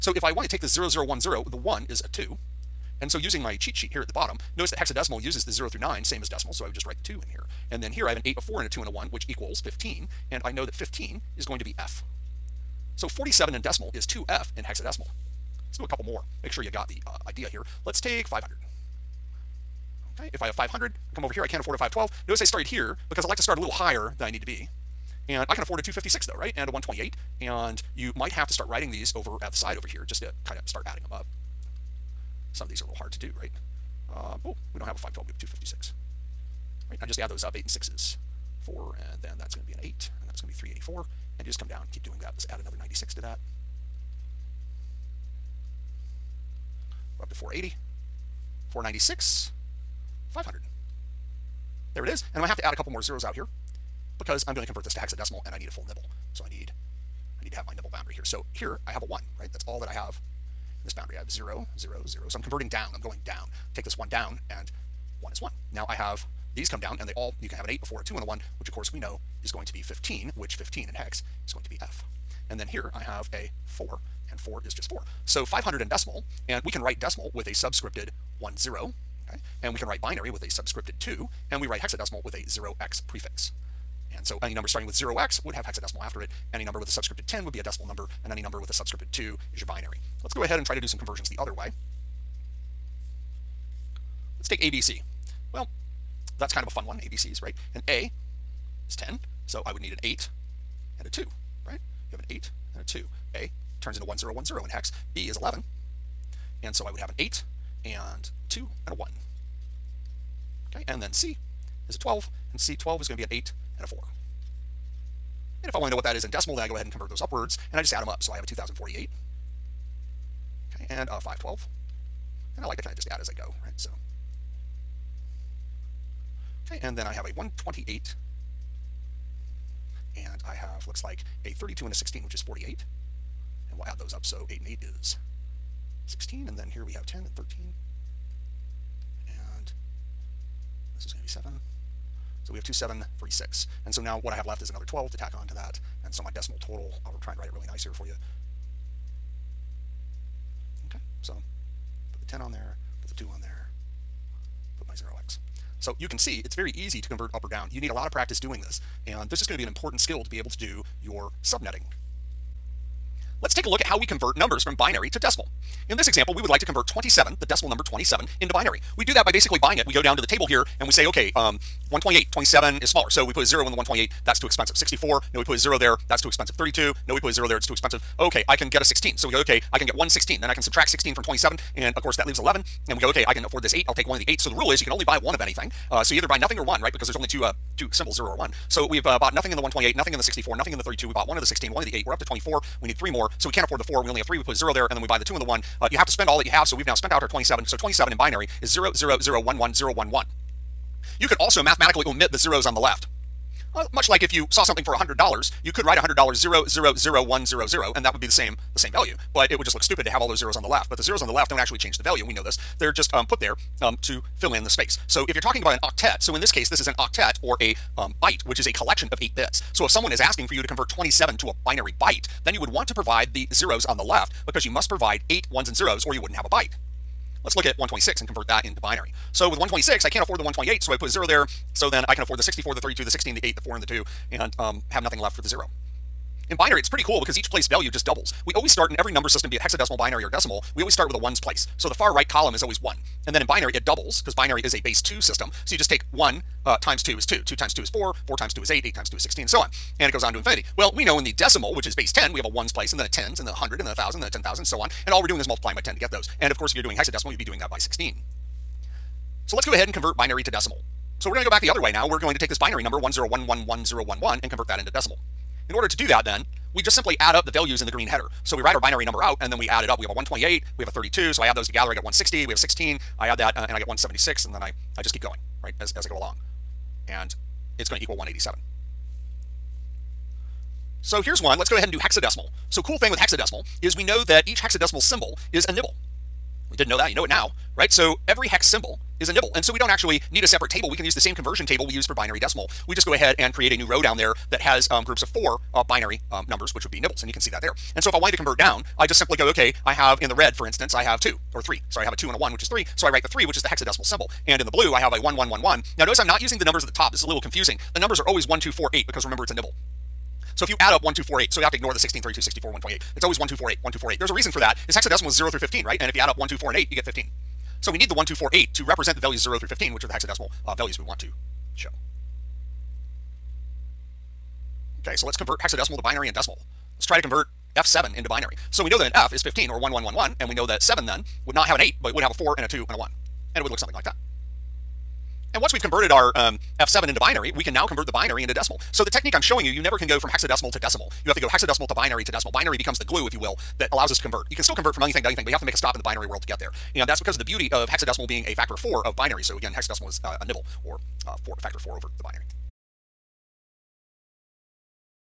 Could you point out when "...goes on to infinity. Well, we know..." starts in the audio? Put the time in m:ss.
4:10.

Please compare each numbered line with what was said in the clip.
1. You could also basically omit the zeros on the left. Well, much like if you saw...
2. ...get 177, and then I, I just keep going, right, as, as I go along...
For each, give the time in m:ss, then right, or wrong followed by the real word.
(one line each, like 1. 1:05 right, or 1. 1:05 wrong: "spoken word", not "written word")
1. 3:21 wrong: "mathematically", not "basically"
2. 4:33 wrong: "176", not "177".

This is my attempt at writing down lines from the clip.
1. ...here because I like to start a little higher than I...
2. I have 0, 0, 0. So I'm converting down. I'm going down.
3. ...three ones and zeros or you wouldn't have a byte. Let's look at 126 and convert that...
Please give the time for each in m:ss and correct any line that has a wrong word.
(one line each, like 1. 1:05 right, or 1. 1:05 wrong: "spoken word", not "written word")
1. 0:22 right
2. 1:01 right
3. 3:45 wrong: "eight", not "three".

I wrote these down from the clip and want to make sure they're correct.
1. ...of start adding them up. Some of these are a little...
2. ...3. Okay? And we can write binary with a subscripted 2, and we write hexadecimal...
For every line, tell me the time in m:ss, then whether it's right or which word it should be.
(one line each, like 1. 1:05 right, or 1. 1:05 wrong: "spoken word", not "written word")
1. 0:30 right
2. 1:18 wrong: "0", not "3".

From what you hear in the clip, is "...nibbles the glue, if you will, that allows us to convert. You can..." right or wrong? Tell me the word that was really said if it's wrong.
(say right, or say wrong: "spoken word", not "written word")
wrong: "becomes", not "nibbles".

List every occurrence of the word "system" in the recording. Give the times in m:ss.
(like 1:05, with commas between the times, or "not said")
3:59, 4:05.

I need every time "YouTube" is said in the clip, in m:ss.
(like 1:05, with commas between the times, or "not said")
not said.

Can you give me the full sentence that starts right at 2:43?
Let's take a look at how we convert numbers from binary to decimal.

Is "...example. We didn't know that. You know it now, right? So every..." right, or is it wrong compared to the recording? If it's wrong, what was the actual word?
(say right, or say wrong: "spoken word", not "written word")
wrong: "nibble", not "example".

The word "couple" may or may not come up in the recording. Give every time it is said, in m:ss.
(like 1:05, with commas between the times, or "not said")
0:15, 0:52.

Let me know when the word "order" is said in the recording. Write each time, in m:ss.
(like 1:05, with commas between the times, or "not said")
4:25.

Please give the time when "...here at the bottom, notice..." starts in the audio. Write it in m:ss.
0:03.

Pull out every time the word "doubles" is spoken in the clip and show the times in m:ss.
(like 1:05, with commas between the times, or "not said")
3:58, 4:03.